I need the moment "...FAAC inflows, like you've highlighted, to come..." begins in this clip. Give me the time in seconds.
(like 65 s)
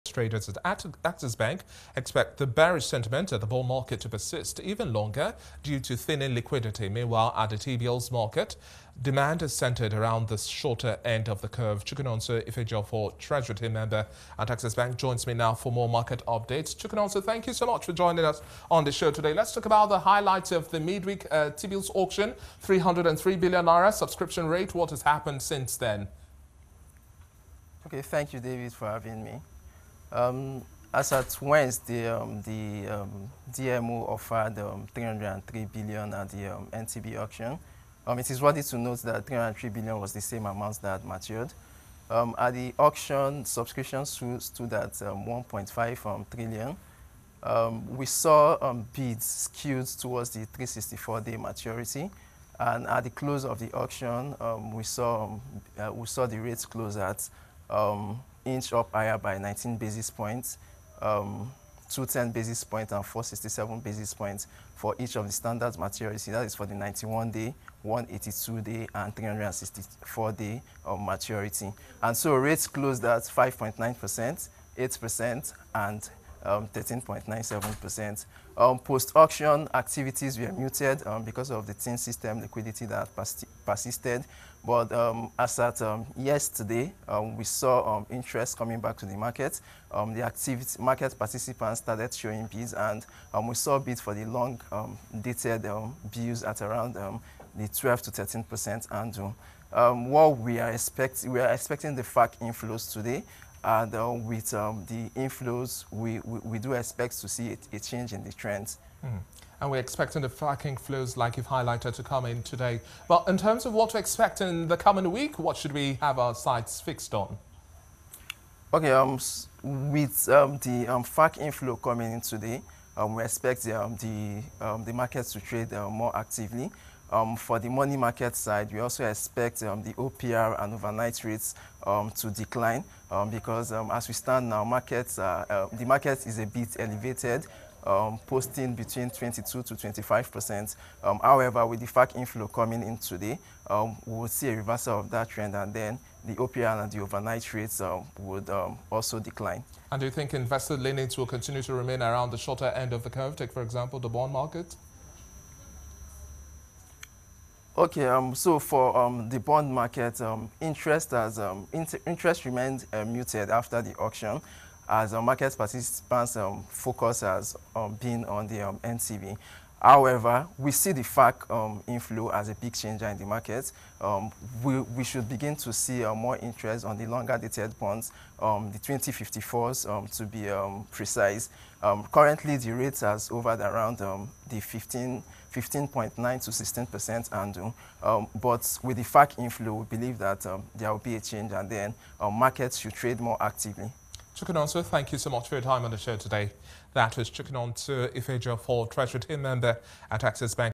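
110 s.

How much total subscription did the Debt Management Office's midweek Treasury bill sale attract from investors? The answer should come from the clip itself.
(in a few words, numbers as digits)
1.5 trillion.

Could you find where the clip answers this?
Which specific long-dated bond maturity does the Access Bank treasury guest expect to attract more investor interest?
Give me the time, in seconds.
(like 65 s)
178 s.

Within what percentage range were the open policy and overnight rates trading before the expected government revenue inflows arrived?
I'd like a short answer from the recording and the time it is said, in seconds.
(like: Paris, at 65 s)
22 to 25 percent, at 139 s.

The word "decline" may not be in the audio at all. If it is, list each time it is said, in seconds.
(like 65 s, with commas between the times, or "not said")
132 s, 149 s.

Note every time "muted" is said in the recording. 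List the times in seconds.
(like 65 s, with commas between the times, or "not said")
80 s, 163 s.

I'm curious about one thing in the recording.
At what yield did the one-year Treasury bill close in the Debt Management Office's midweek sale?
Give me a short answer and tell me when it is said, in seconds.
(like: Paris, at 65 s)
13.97%, at 76 s.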